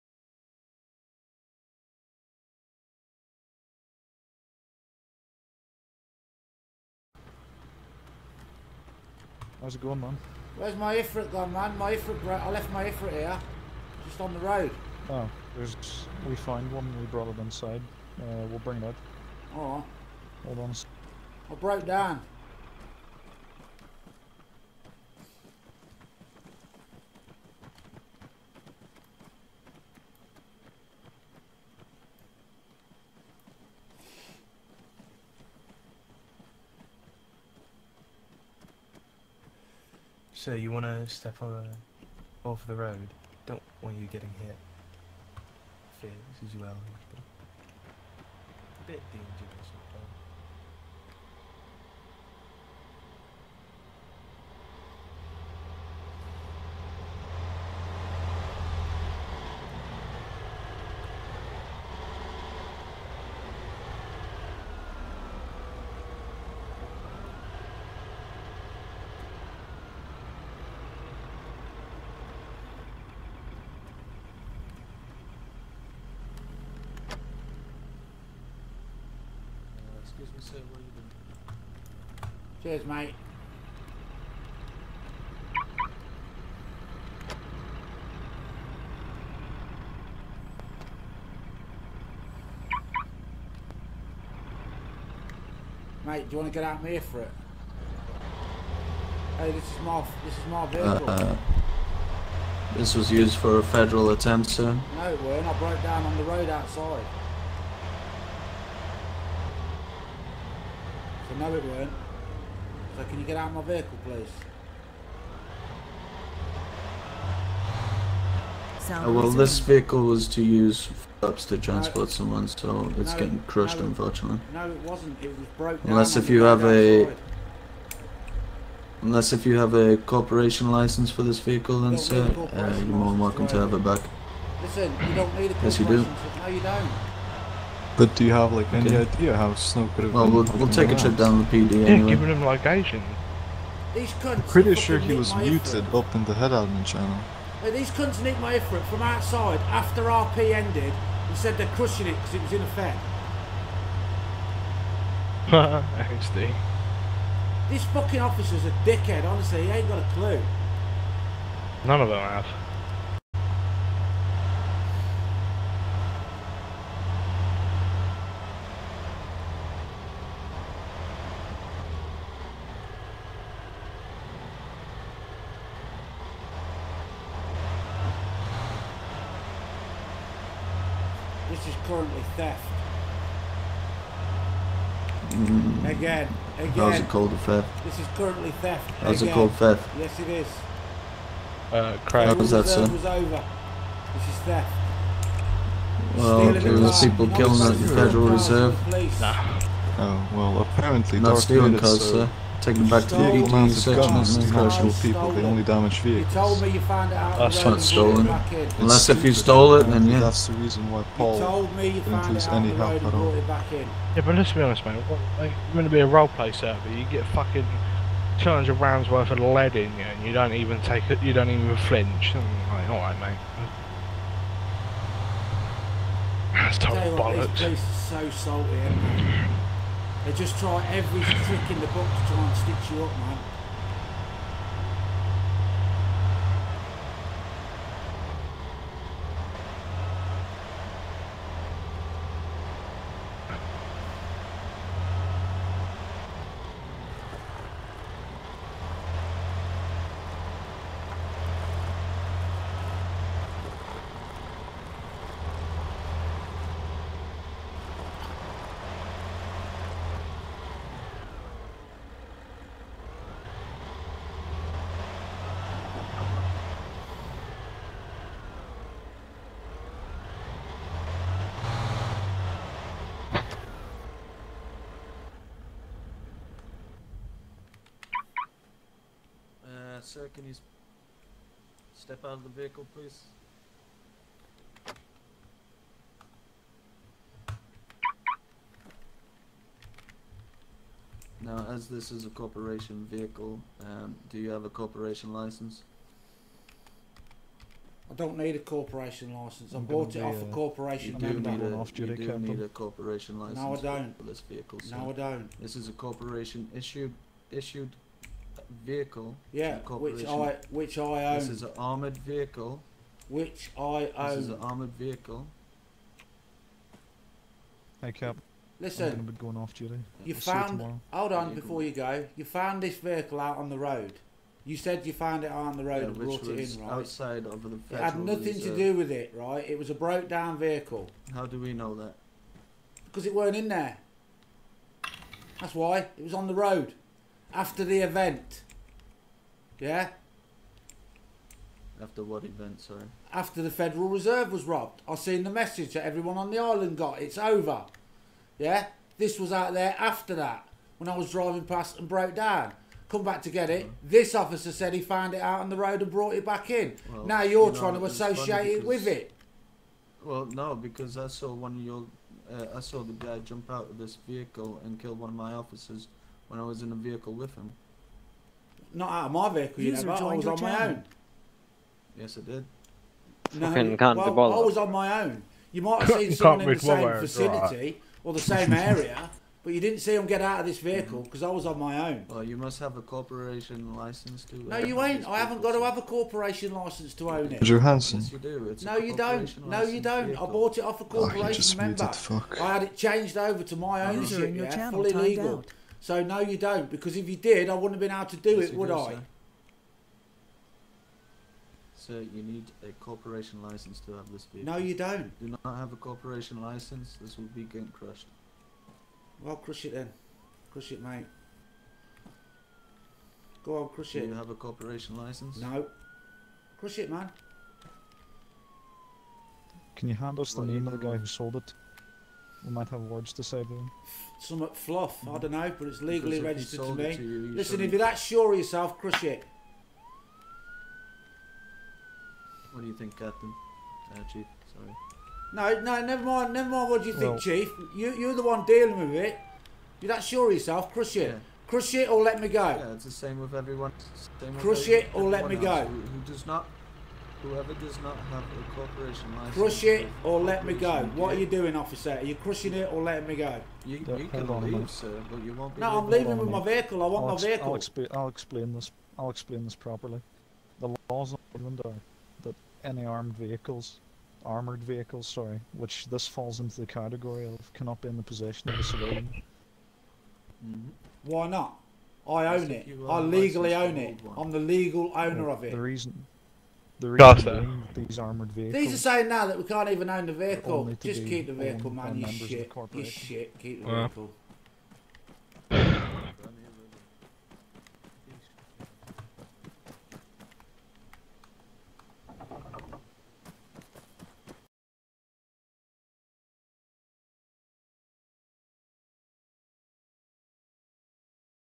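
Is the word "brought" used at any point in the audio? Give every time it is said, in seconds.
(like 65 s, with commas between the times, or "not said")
17 s, 326 s, 356 s.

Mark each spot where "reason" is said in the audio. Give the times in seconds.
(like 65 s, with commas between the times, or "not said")
210 s, 475 s.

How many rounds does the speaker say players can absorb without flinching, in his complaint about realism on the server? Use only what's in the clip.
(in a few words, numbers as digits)
200.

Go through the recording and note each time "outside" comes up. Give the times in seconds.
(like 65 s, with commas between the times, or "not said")
106 s, 127 s, 149 s, 326 s.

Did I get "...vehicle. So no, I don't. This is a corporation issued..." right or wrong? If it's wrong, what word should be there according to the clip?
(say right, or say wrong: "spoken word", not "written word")
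right.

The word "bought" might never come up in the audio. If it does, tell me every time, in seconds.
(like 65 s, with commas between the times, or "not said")
299 s, 390 s.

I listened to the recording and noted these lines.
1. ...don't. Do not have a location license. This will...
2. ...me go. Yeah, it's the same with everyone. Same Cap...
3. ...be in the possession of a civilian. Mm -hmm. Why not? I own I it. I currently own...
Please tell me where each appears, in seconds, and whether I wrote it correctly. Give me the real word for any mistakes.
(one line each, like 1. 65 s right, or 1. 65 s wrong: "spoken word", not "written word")
1. 404 s wrong: "corporation", not "location"
2. 442 s wrong: "Crush", not "Cap"
3. 468 s wrong: "legally", not "currently".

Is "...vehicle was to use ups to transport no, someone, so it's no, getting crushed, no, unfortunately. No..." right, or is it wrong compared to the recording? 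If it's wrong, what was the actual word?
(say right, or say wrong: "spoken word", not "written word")
right.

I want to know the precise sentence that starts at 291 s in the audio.
Now, as this is a corporation vehicle, um, do you have a corporation license?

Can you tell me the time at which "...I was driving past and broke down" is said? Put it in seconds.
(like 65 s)
351 s.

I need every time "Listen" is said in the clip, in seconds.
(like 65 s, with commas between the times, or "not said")
134 s, 318 s, 427 s.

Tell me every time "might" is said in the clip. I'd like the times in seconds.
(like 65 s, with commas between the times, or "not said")
375 s, 422 s.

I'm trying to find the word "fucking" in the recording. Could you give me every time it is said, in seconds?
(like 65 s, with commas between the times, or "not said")
157 s, 217 s.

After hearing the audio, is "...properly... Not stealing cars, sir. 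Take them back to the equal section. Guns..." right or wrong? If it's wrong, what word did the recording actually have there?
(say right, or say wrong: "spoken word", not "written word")
wrong: "apparently", not "properly".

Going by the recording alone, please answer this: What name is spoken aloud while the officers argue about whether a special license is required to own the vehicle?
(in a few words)
Andrew Hansen.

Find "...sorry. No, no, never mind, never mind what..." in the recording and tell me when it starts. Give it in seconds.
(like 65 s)
434 s.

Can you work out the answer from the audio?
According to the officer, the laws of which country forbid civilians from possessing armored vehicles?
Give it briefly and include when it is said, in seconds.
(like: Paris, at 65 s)
England, at 461 s.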